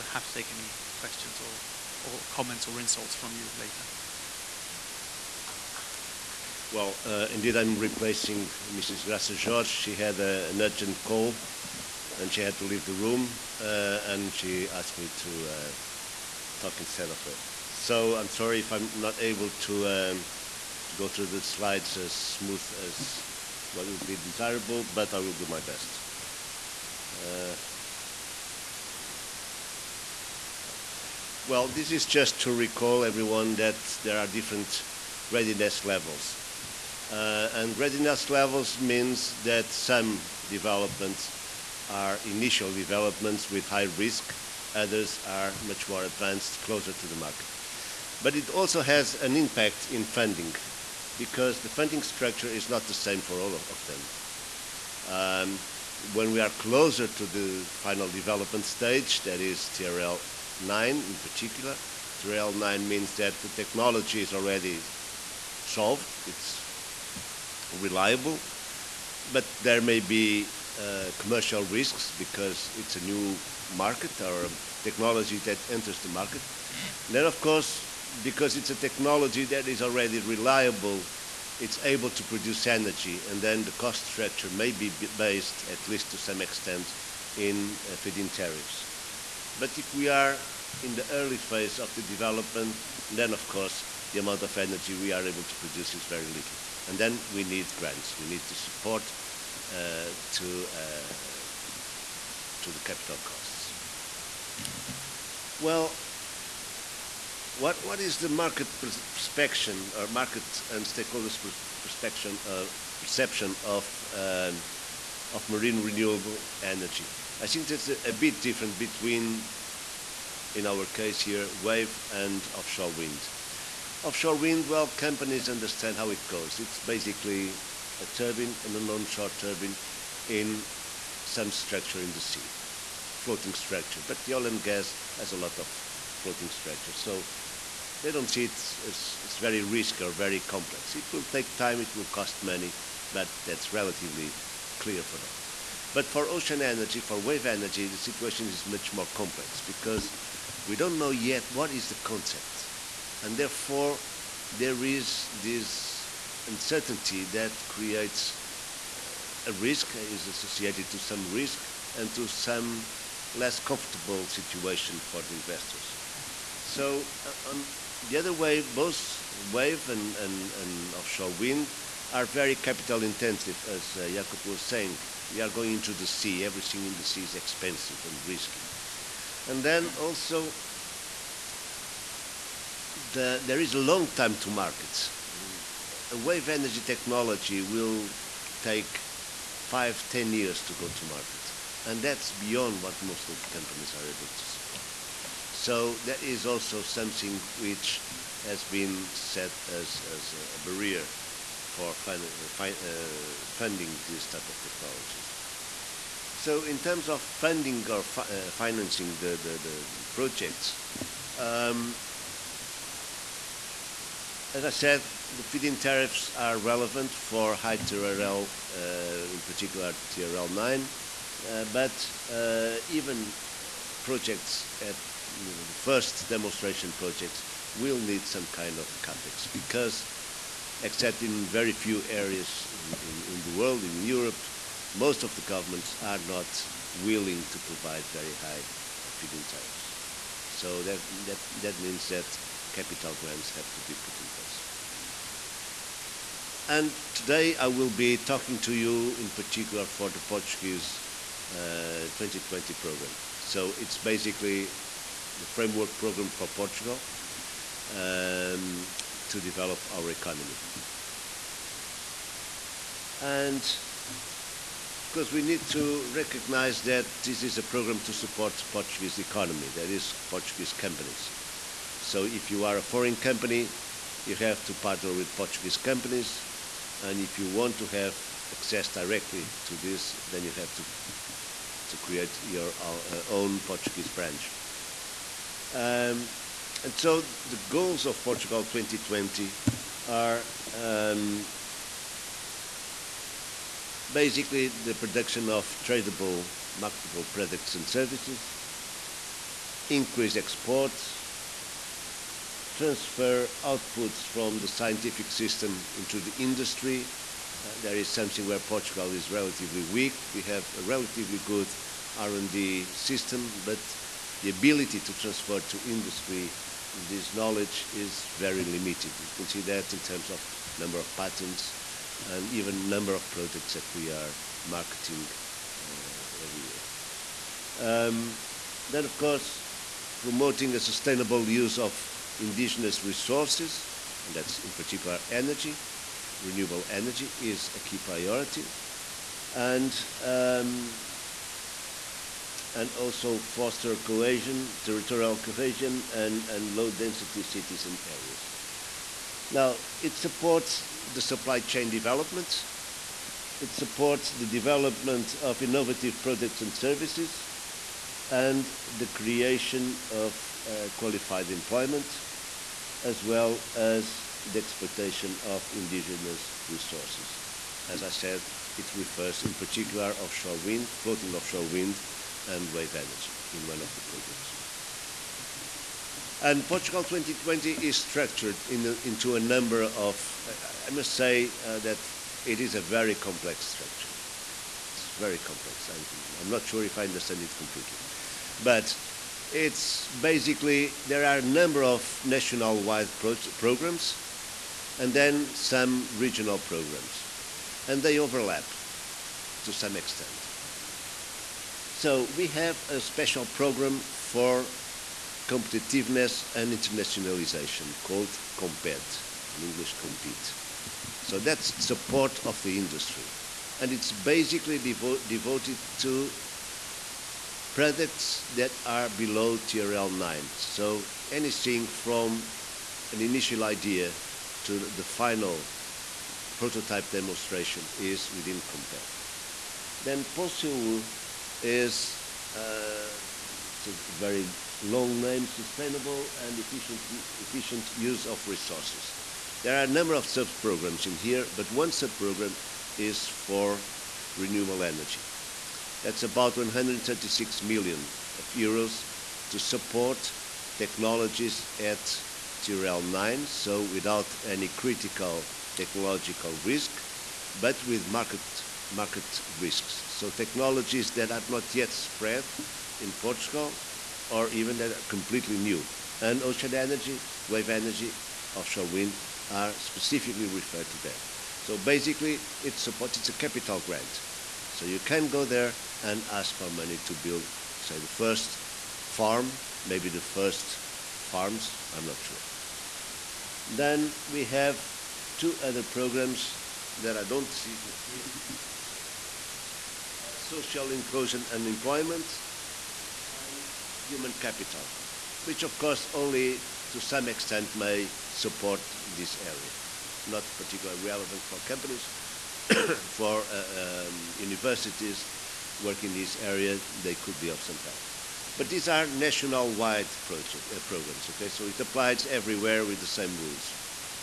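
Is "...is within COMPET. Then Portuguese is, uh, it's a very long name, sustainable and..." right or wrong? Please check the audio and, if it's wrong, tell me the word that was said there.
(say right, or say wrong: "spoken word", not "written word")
wrong: "POSEUR", not "Portuguese".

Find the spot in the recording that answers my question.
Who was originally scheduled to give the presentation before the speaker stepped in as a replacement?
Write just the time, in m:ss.
0:09.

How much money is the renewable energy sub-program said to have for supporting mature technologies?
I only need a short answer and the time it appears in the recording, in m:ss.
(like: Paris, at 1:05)
136 million euros, at 7:26.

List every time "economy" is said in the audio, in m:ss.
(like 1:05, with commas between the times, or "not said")
4:20, 4:29.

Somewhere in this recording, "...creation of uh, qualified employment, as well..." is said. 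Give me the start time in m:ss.
5:59.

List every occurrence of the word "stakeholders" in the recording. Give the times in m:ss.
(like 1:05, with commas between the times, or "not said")
1:50.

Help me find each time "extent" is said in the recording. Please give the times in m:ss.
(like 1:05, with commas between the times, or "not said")
1:26, 6:39, 8:17.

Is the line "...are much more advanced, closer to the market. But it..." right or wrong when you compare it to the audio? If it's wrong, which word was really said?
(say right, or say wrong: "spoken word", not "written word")
right.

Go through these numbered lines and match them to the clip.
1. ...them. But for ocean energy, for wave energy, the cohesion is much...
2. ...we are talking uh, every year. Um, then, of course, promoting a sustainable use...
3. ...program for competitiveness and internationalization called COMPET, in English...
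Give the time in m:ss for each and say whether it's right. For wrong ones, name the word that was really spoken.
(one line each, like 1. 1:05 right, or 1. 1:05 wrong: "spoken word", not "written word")
1. 2:25 wrong: "situation", not "cohesion"
2. 5:23 wrong: "marketing", not "talking"
3. 6:43 right.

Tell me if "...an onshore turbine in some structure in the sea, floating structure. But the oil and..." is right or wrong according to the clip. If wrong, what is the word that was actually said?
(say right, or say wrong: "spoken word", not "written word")
right.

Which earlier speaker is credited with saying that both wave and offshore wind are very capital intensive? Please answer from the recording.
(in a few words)
Jacopo.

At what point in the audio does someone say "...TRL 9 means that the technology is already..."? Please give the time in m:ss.
1:02.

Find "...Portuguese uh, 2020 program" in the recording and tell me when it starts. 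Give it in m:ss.
4:10.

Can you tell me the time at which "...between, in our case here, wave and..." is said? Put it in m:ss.
1:58.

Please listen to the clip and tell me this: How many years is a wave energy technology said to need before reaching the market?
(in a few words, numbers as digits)
5 to 10 years.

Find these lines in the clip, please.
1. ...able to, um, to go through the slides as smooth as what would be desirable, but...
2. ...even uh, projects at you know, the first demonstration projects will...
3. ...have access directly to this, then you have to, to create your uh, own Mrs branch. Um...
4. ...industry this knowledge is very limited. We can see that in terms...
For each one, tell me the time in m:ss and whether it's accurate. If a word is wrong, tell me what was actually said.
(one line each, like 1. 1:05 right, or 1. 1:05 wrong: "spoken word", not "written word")
1. 0:19 right
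2. 3:42 right
3. 4:37 wrong: "Portuguese", not "Mrs"
4. 5:15 right.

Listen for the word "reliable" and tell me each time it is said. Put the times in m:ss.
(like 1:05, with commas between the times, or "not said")
1:07, 1:20.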